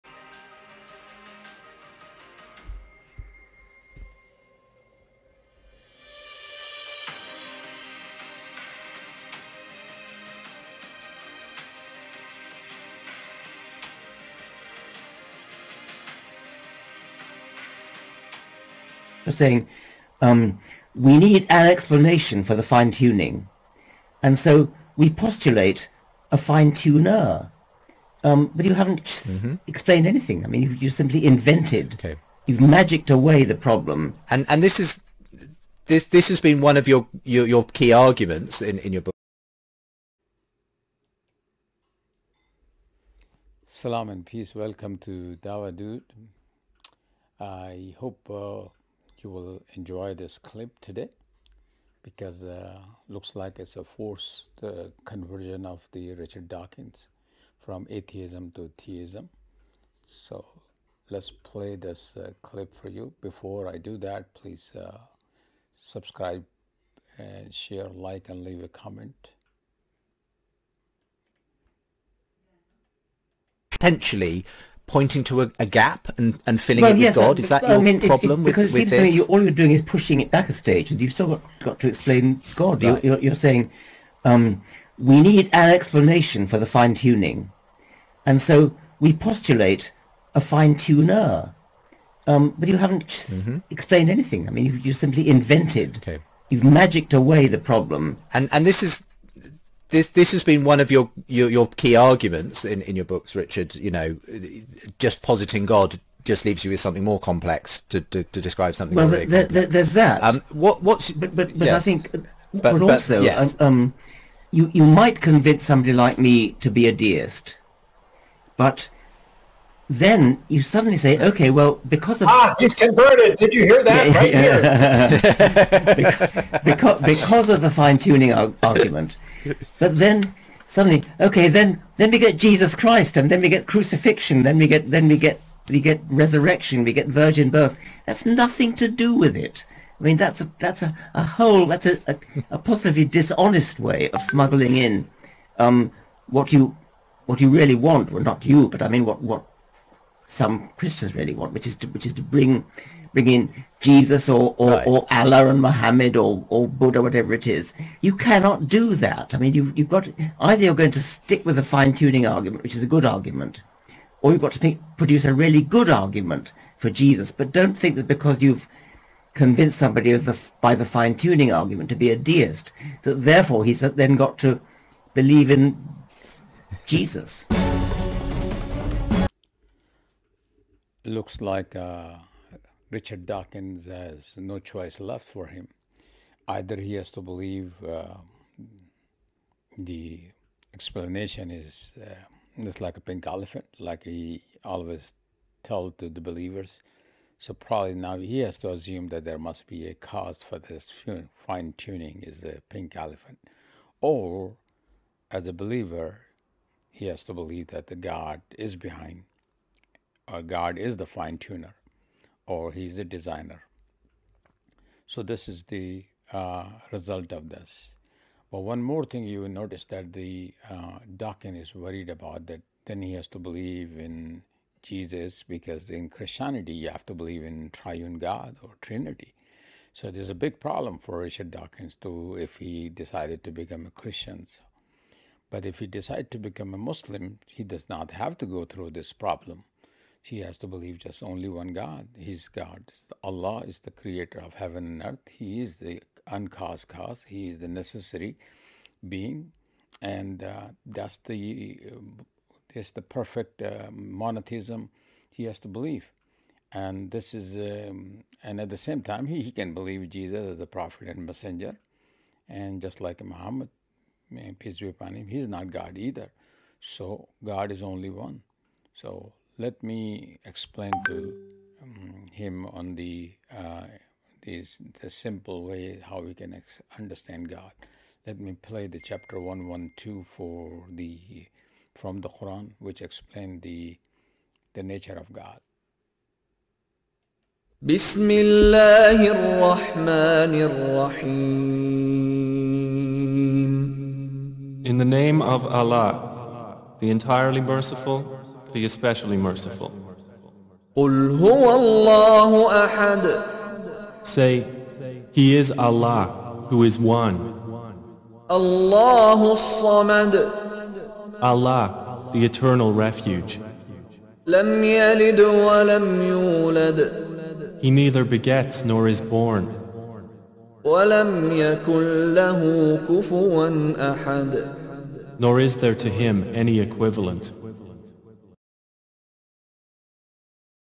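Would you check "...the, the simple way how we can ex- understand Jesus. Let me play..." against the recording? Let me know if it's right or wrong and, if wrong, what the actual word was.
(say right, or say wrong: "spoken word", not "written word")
wrong: "God", not "Jesus".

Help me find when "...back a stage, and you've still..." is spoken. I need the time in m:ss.
1:20.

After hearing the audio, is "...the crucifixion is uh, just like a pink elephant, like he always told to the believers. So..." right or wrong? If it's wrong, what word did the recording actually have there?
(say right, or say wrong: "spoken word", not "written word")
wrong: "explanation", not "crucifixion".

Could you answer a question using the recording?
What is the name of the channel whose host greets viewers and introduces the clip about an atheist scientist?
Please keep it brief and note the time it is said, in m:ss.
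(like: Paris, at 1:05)
Dawahdude, at 0:45.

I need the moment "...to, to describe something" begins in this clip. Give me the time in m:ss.
1:48.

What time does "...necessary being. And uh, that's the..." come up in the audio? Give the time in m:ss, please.
4:07.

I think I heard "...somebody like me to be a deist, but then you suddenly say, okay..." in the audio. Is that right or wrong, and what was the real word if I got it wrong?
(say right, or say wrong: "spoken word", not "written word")
right.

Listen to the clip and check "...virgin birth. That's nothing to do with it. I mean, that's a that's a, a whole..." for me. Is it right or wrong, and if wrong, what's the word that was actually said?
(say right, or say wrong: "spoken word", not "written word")
right.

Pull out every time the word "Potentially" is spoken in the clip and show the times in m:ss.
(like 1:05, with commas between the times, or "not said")
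1:13.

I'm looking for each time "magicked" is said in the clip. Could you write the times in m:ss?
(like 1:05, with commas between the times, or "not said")
0:32, 1:36.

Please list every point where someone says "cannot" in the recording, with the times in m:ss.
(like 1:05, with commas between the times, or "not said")
2:38.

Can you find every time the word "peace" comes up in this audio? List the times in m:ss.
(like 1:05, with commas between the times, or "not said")
0:44, 4:24.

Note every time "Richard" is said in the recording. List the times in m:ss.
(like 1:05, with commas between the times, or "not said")
0:56, 1:43, 3:02, 3:51.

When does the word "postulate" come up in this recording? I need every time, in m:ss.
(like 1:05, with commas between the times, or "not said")
0:25, 1:29.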